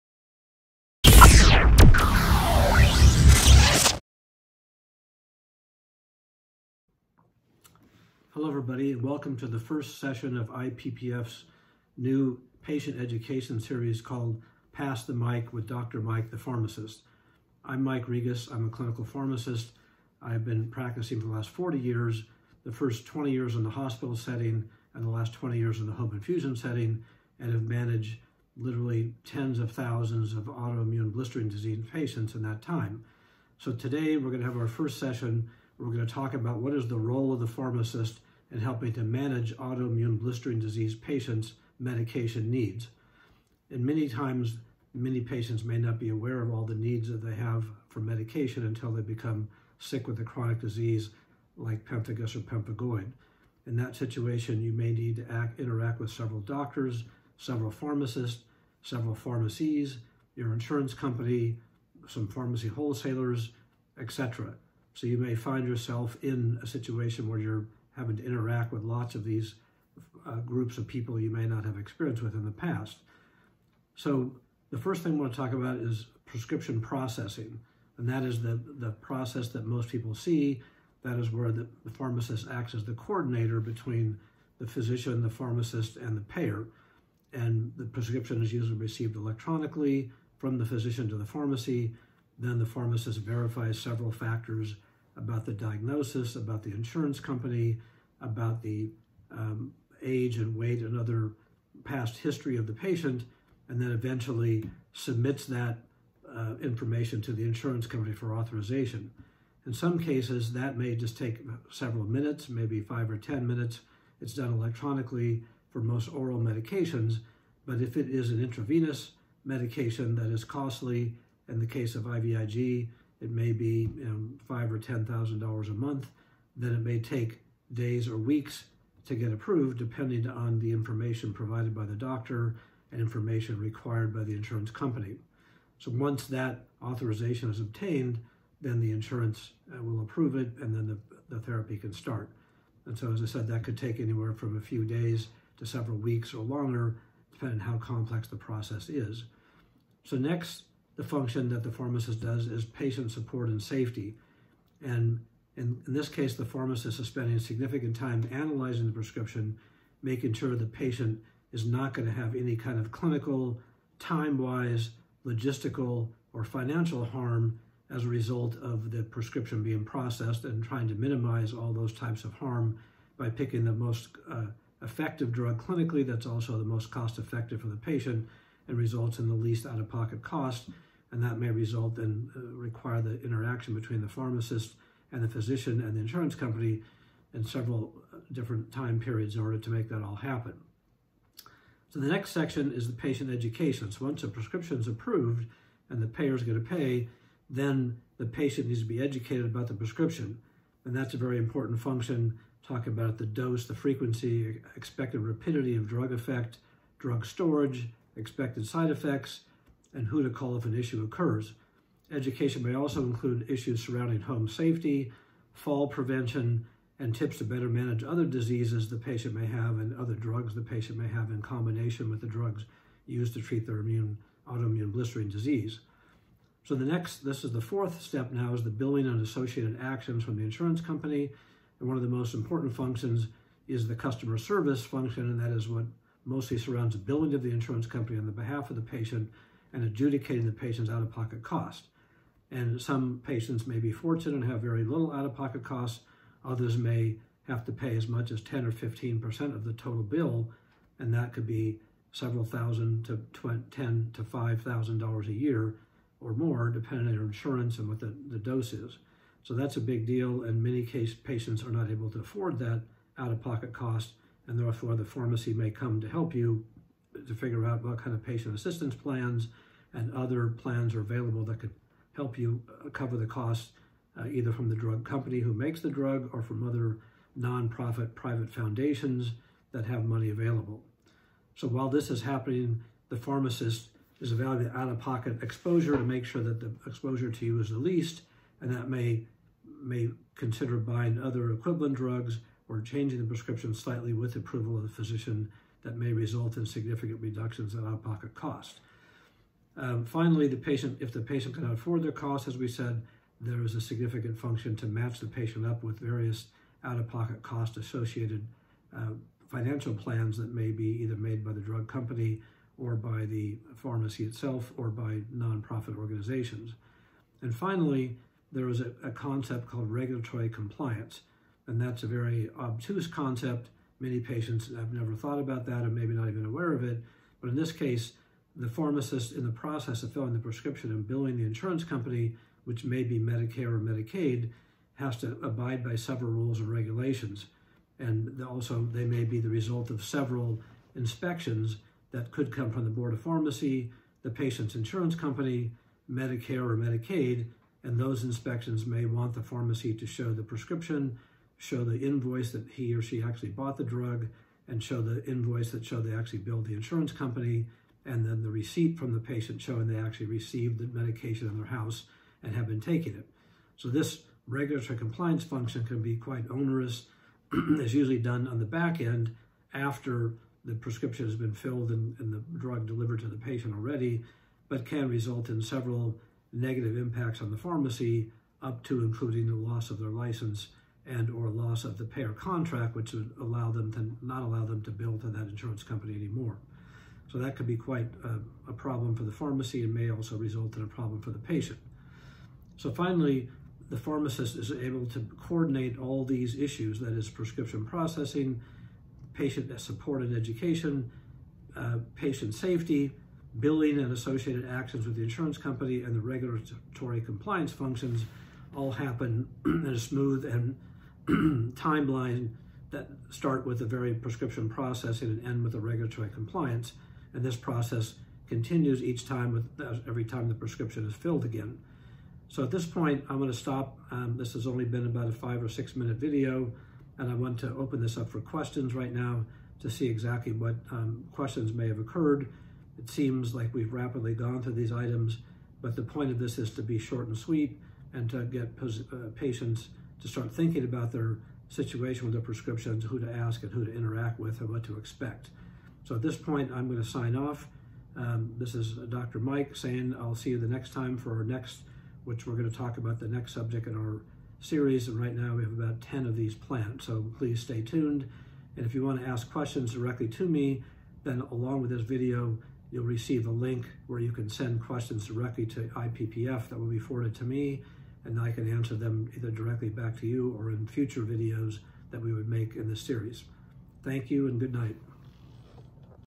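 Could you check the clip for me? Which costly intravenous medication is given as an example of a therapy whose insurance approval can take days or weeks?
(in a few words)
IVIG.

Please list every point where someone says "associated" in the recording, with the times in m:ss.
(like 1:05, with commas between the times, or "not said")
3:49, 5:07, 6:44.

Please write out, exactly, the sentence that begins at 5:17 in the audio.
And finally, there is a, a concept called regulatory compliance.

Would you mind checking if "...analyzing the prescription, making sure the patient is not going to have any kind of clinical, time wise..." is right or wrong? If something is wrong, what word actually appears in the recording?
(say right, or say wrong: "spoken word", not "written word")
right.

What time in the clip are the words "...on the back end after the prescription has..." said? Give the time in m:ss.
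6:08.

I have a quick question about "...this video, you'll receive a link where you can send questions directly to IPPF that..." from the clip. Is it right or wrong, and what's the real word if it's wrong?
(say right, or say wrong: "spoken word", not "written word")
right.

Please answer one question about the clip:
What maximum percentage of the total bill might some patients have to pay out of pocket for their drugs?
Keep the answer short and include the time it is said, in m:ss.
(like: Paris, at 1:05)
15%, at 4:08.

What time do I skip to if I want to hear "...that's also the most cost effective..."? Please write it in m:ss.
2:56.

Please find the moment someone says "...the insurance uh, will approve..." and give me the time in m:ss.
2:18.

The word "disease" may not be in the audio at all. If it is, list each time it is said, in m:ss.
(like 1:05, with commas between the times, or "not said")
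0:31, 0:40, 0:50, 3:38, 3:45.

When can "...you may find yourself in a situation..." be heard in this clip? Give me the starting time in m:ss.
1:05.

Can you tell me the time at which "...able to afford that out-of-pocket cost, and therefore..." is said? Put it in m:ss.
4:21.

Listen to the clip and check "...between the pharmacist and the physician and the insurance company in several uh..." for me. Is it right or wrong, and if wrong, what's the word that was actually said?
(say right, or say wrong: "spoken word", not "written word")
right.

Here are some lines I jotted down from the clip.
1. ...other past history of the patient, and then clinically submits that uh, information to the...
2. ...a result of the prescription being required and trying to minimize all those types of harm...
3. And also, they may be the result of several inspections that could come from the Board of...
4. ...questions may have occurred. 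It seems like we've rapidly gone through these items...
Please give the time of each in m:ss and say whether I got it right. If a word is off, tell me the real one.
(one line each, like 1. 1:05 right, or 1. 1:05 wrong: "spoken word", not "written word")
1. 1:40 wrong: "eventually", not "clinically"
2. 2:48 wrong: "processed", not "required"
3. 5:37 right
4. 7:11 right.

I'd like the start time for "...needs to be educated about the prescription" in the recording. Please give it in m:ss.
3:18.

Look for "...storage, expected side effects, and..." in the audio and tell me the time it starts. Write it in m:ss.
3:27.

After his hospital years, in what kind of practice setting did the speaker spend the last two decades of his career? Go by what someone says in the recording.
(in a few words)
home infusion.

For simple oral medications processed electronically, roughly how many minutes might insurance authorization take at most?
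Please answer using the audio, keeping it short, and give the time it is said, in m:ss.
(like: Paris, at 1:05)
10 minutes, at 1:53.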